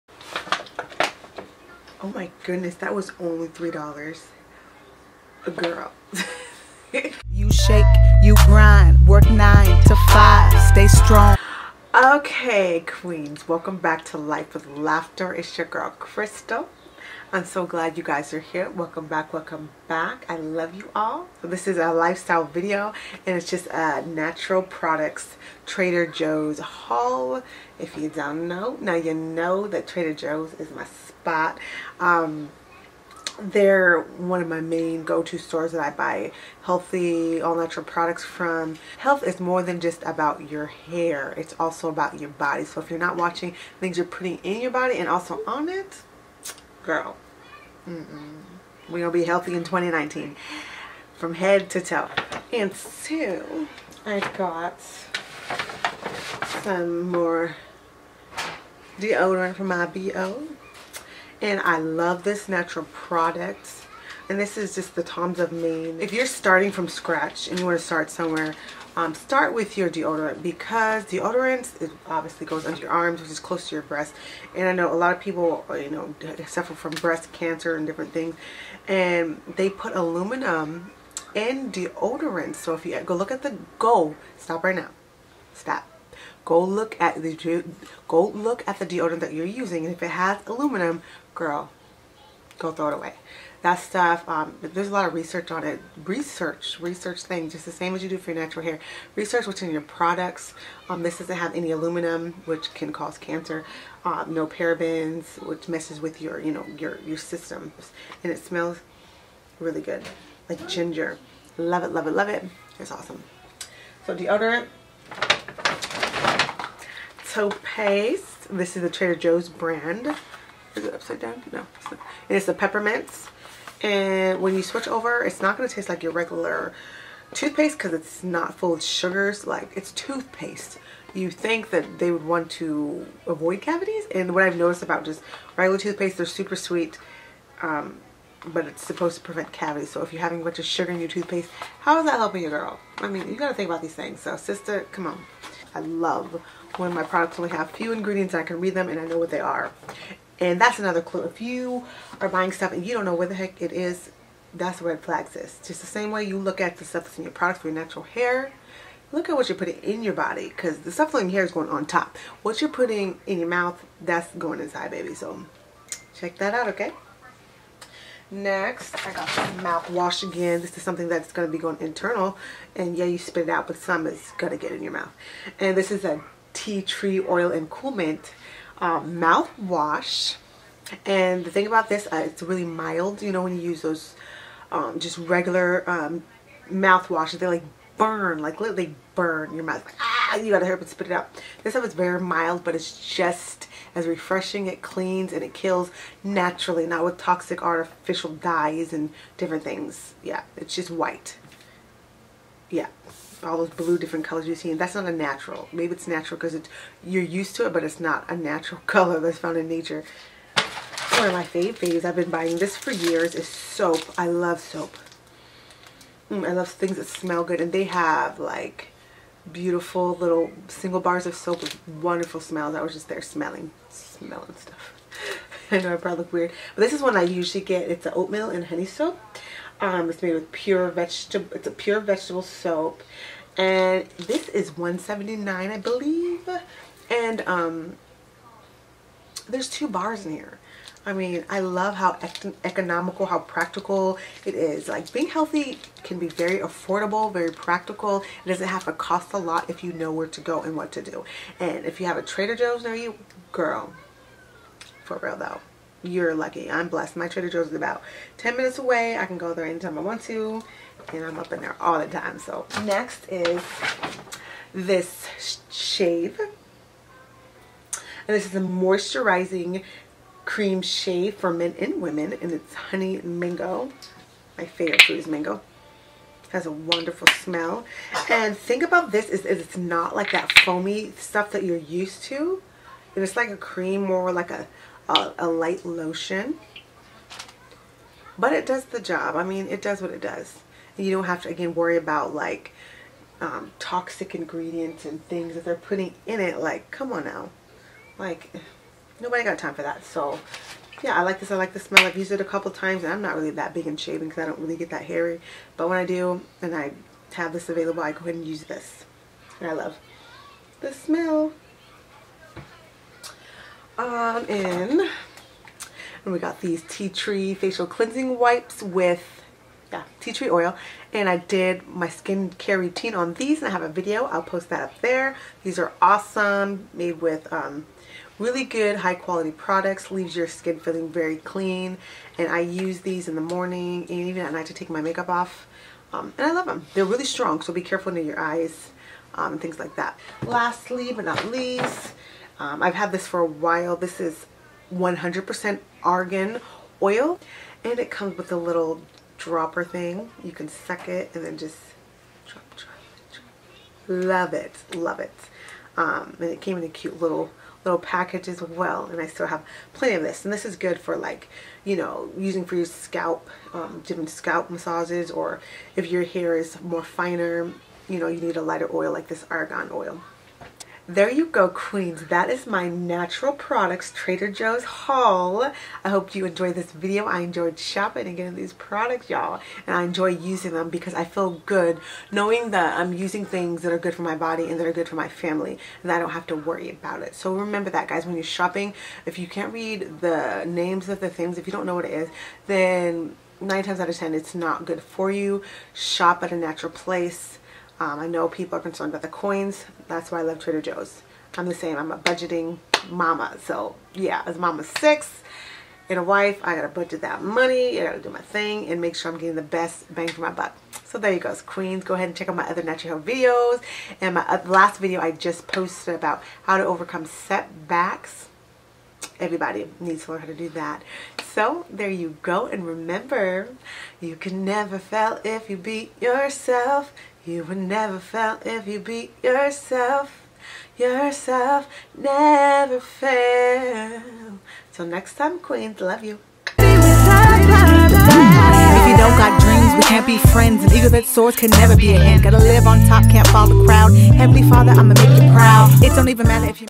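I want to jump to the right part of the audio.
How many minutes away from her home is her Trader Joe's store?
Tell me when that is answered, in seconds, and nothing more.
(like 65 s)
258 s.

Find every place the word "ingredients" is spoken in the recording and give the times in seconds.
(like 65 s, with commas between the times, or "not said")
147 s, 294 s.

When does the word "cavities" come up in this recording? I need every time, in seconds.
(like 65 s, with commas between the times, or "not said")
133 s, 139 s.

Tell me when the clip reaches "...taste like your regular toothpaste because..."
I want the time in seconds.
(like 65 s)
125 s.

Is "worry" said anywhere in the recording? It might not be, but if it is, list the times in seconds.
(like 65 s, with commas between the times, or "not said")
291 s, 386 s.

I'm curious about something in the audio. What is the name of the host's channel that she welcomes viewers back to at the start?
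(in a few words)
Life with Laughter.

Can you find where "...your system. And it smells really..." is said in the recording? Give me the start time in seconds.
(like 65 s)
106 s.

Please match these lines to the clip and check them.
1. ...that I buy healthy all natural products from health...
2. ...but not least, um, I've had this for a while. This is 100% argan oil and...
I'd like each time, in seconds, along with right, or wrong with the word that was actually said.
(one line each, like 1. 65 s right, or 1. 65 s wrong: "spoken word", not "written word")
1. 35 s right
2. 341 s right.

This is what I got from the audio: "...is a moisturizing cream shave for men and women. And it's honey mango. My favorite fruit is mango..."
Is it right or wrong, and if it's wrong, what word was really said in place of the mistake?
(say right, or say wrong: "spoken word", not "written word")
right.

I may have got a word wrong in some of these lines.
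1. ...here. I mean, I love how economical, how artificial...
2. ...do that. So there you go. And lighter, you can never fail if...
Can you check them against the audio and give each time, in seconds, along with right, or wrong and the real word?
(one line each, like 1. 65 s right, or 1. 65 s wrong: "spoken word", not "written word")
1. 240 s wrong: "practical", not "artificial"
2. 420 s wrong: "remember", not "lighter".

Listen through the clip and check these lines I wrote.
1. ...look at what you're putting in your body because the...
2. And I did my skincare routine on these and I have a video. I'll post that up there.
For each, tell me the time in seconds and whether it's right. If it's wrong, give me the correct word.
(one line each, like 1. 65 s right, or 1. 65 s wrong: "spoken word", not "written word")
1. 159 s right
2. 321 s right.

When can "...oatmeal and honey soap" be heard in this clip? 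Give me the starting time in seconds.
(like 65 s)
228 s.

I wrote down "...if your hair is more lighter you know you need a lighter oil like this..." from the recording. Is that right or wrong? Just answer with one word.
wrong.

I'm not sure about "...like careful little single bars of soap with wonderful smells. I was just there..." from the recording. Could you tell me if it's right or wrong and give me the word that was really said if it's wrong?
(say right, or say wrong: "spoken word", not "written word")
wrong: "beautiful", not "careful".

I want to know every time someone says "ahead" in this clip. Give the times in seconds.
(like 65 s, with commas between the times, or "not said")
308 s, 412 s.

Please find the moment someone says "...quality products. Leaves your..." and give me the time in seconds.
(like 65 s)
329 s.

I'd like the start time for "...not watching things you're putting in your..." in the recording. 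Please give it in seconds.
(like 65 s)
42 s.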